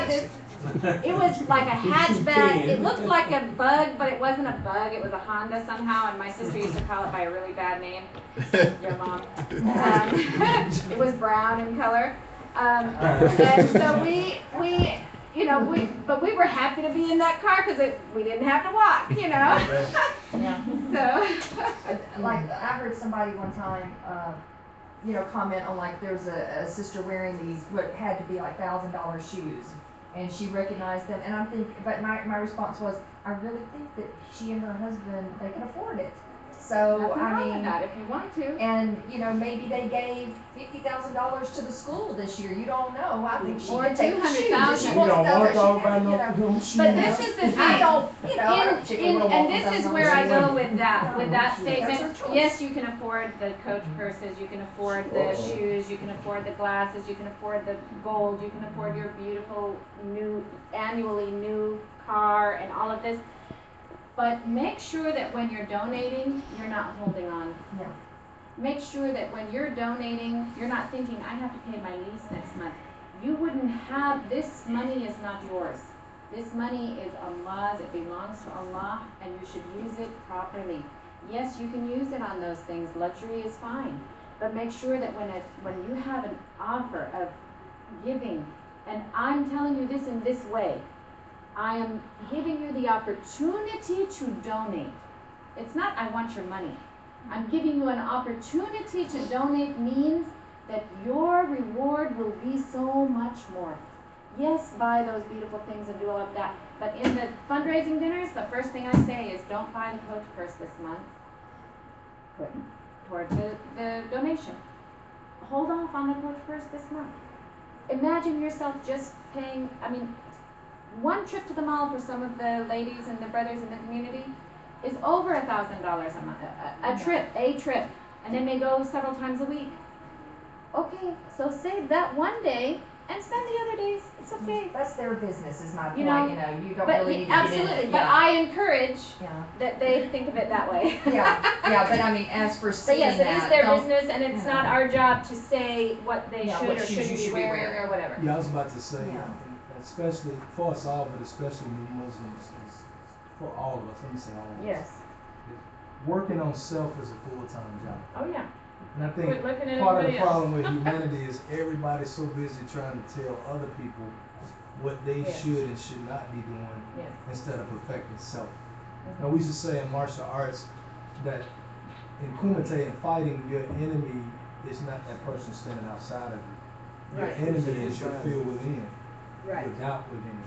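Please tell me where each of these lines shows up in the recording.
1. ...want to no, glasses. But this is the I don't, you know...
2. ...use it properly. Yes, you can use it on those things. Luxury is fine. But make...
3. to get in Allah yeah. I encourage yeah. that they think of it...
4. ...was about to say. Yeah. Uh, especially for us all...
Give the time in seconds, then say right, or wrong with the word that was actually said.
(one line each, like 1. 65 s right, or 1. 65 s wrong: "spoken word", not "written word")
1. 45 s wrong: "shoes", not "glasses"
2. 79 s right
3. 137 s wrong: "But", not "Allah"
4. 148 s right.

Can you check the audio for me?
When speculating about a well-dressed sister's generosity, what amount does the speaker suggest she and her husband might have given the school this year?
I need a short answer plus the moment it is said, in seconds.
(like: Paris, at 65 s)
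$50,000, at 40 s.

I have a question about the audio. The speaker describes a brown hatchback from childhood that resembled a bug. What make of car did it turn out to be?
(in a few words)
Honda.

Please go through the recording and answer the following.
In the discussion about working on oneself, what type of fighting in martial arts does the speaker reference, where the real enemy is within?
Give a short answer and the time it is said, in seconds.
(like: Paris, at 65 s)
Kumite, at 172 s.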